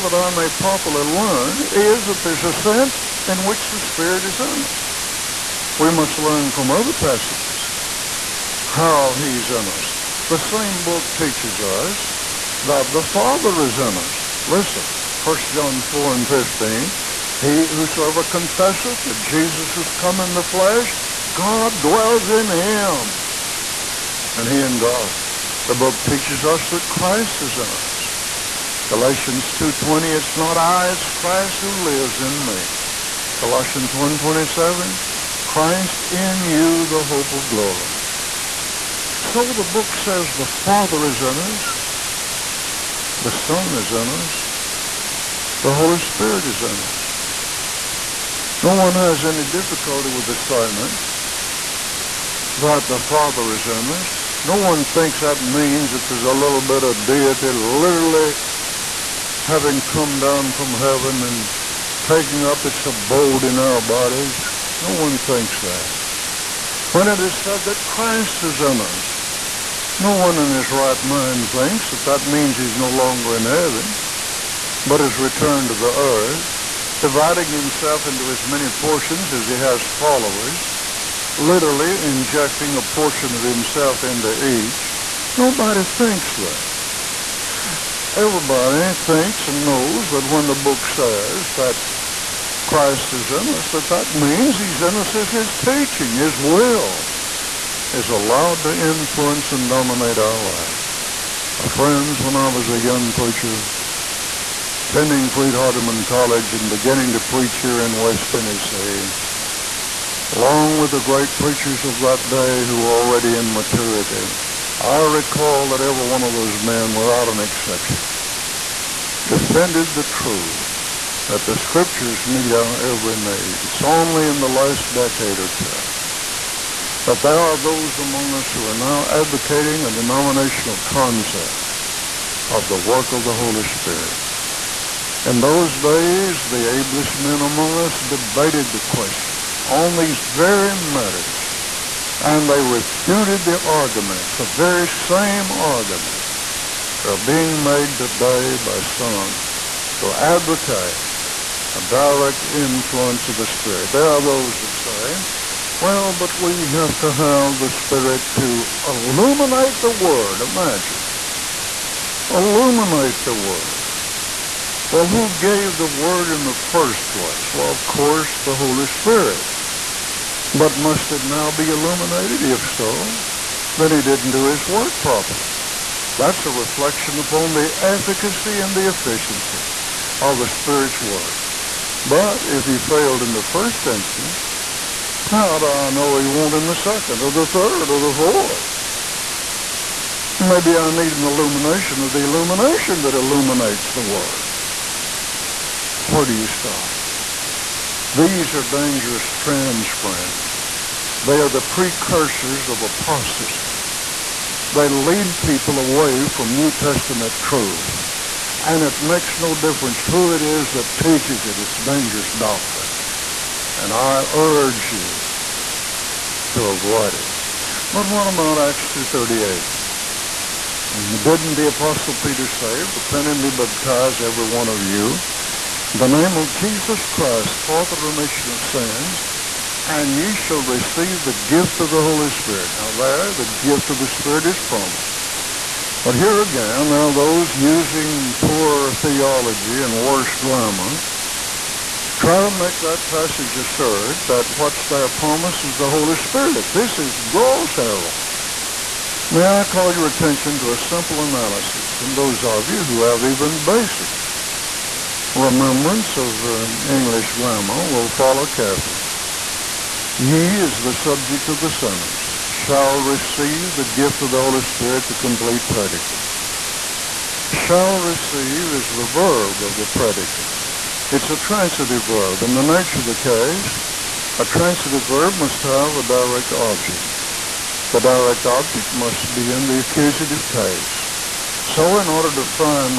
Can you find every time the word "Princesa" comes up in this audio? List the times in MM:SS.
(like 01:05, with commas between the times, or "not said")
not said.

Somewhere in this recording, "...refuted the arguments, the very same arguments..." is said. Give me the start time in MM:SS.
02:22.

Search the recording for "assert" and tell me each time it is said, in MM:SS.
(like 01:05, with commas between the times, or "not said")
04:03.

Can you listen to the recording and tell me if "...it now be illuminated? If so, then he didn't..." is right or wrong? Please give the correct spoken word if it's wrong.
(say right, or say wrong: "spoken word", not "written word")
right.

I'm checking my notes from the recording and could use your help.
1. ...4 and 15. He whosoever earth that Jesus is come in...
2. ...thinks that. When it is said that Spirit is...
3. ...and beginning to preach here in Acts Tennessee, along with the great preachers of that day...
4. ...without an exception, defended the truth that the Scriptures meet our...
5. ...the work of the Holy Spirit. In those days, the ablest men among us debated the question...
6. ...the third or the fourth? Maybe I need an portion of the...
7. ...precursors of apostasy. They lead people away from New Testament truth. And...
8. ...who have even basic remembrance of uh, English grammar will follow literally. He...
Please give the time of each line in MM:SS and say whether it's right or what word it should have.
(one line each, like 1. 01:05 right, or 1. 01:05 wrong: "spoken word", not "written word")
1. 00:15 wrong: "confesseth", not "earth"
2. 01:05 wrong: "Christ", not "Spirit"
3. 01:46 wrong: "West", not "Acts"
4. 01:56 right
5. 02:12 right
6. 03:07 wrong: "illumination", not "portion"
7. 03:21 right
8. 04:12 wrong: "carefully", not "literally".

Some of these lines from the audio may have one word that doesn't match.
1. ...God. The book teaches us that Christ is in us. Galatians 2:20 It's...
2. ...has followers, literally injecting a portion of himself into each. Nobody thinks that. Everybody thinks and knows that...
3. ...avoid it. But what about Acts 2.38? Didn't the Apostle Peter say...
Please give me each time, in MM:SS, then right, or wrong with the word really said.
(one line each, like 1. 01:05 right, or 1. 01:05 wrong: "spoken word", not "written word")
1. 00:24 right
2. 01:19 right
3. 03:36 right.